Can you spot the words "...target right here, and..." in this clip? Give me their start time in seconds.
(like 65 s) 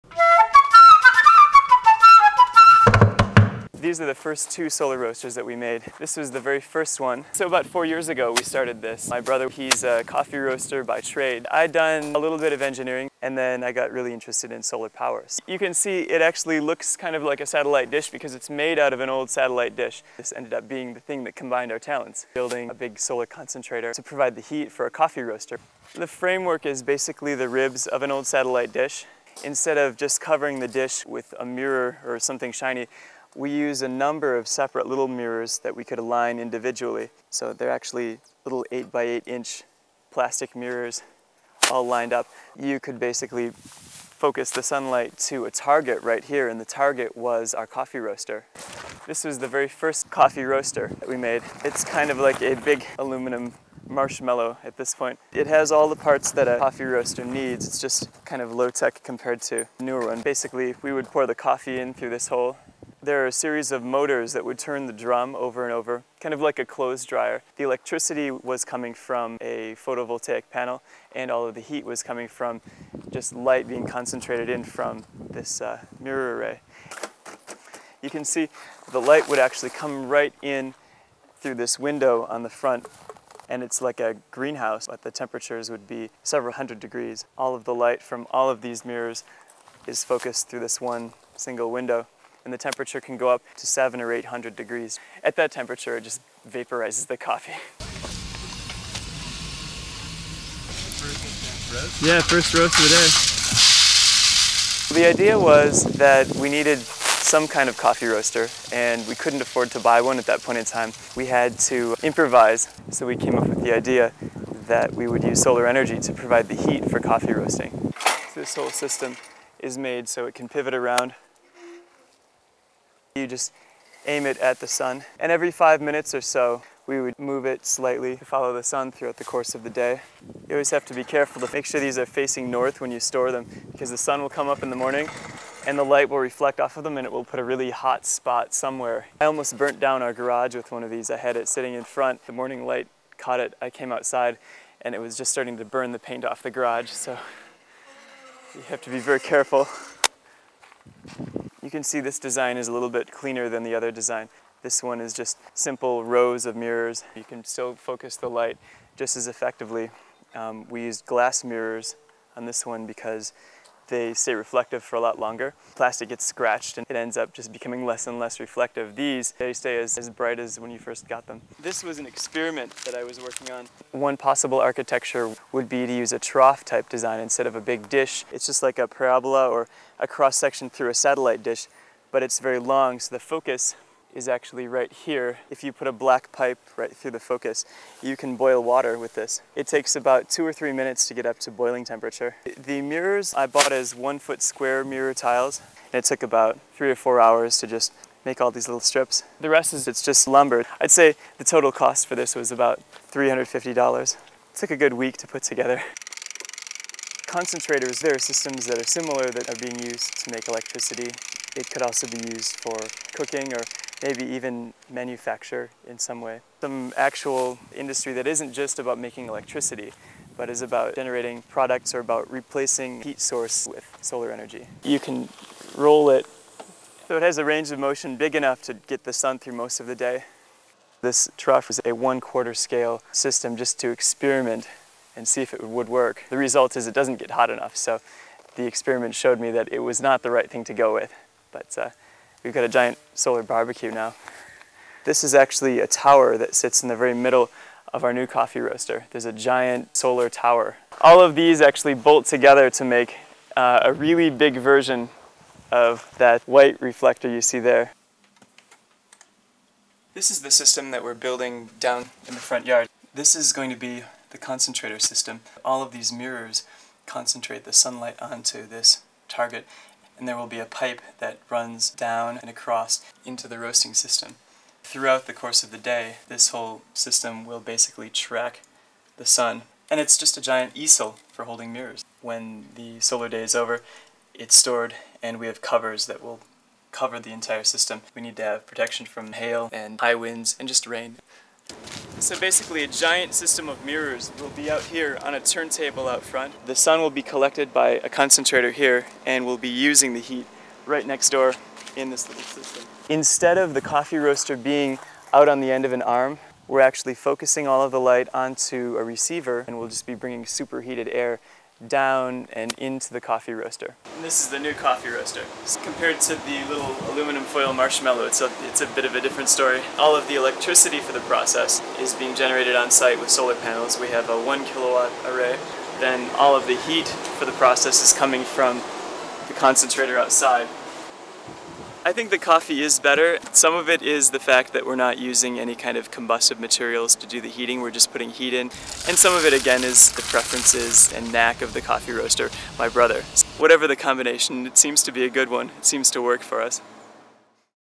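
45 s.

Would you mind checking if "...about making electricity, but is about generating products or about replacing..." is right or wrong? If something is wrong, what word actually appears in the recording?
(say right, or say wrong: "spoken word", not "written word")
right.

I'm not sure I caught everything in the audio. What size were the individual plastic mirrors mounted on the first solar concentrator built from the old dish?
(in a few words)
8 by 8 inch.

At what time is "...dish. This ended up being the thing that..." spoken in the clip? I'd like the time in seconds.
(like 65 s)
19 s.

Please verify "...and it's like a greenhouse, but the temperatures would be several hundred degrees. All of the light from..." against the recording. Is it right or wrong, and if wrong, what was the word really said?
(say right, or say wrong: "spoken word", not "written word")
right.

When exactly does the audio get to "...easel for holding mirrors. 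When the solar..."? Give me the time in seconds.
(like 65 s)
280 s.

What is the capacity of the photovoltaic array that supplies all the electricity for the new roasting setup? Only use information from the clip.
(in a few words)
1 kilowatt.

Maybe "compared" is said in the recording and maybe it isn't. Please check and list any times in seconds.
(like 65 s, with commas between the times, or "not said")
59 s, 315 s.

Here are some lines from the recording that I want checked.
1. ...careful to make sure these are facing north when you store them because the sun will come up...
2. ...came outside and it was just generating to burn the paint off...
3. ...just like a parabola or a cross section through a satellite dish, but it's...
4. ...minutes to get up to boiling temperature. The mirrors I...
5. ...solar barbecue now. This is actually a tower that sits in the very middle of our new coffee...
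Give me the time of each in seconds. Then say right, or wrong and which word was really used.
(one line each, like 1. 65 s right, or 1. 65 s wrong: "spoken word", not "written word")
1. 131 s right
2. 143 s wrong: "starting", not "generating"
3. 178 s right
4. 190 s right
5. 243 s right.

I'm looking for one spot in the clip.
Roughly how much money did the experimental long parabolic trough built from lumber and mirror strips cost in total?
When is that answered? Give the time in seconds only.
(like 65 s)
203 s.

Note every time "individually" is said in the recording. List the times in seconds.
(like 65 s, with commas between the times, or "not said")
36 s.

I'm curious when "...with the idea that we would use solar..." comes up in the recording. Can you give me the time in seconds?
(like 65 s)
113 s.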